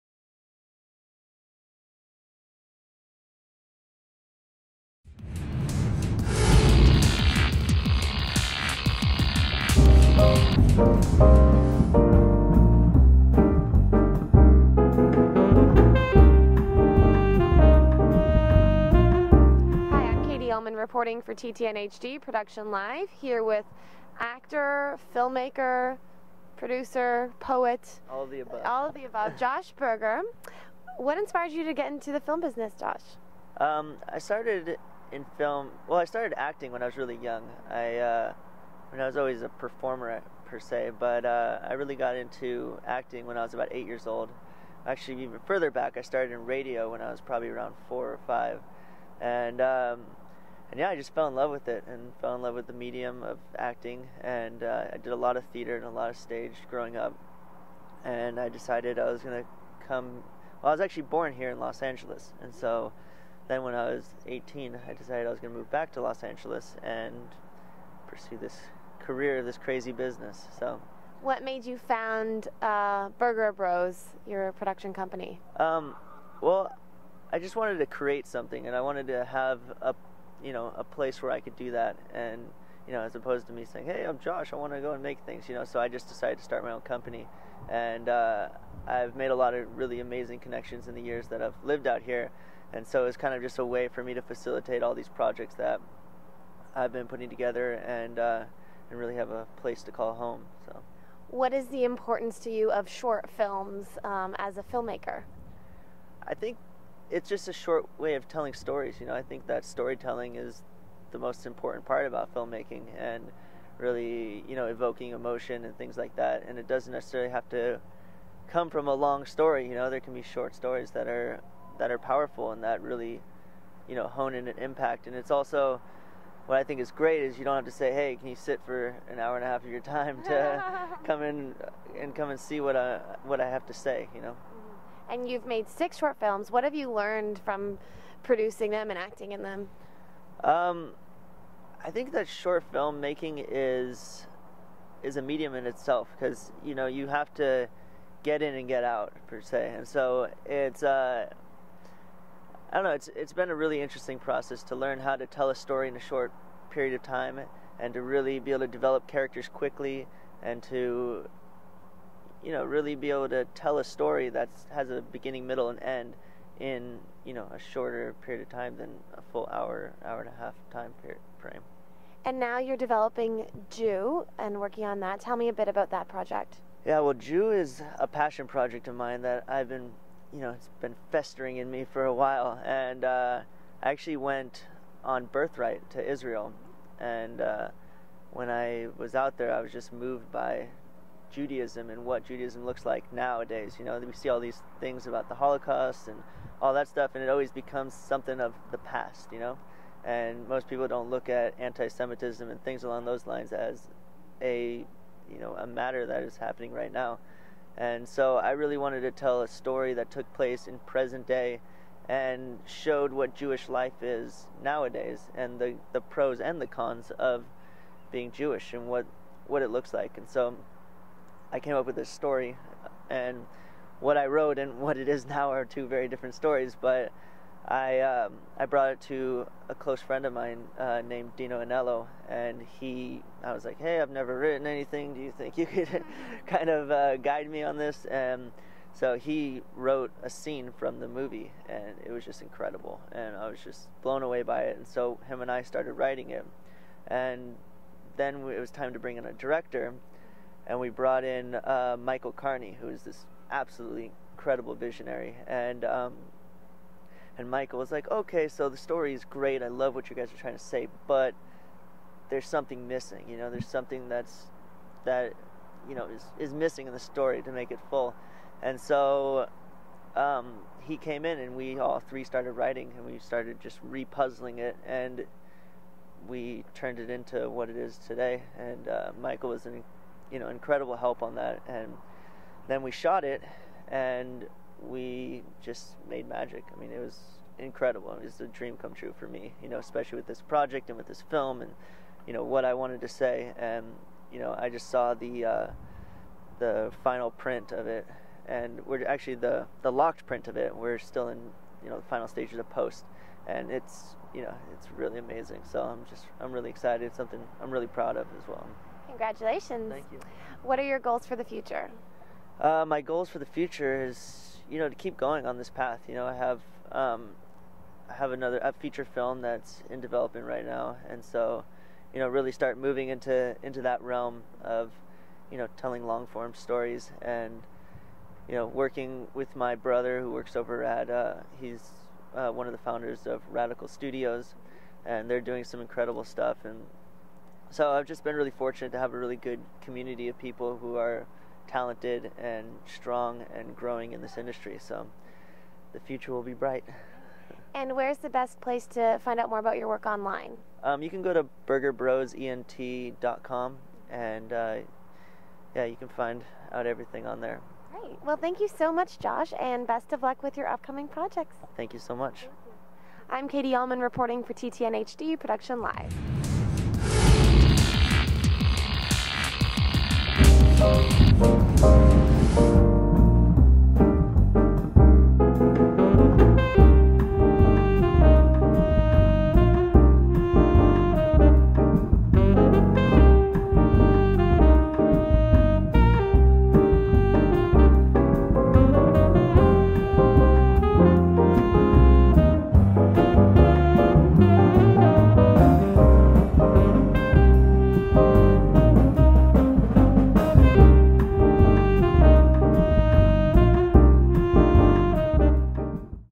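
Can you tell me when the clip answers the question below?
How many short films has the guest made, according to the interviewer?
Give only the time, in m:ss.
2:15.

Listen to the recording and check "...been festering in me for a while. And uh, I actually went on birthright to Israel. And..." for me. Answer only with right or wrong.
right.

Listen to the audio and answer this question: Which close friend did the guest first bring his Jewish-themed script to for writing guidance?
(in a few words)
Dino Anello.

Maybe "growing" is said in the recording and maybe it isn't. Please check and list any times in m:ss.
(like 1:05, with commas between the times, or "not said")
0:56, 5:43.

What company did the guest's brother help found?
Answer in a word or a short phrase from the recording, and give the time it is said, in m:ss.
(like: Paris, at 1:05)
Radical Studios, at 5:33.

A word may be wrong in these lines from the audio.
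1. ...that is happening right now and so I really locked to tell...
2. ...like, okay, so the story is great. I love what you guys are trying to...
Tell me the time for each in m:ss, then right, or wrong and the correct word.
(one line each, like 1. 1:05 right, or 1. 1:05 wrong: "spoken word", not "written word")
1. 3:26 wrong: "wanted", not "locked"
2. 4:17 right.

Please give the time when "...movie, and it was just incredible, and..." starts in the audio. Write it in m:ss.
4:01.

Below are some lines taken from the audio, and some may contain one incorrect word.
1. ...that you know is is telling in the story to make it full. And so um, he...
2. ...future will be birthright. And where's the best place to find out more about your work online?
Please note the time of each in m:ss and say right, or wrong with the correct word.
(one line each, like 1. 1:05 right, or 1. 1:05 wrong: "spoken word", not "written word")
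1. 4:25 wrong: "missing", not "telling"
2. 5:45 wrong: "bright", not "birthright".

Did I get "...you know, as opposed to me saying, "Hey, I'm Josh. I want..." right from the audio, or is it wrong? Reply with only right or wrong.
right.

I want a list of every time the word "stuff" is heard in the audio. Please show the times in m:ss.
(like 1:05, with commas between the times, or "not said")
3:16, 5:36.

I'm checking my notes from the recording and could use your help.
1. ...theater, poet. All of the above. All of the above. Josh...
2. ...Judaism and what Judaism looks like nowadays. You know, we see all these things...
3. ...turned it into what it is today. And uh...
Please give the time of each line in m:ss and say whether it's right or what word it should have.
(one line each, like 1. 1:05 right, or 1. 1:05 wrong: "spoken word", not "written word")
1. 0:26 wrong: "producer", not "theater"
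2. 3:11 right
3. 4:36 right.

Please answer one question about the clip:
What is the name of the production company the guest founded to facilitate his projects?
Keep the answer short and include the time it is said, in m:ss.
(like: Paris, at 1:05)
Berger Bros, at 1:13.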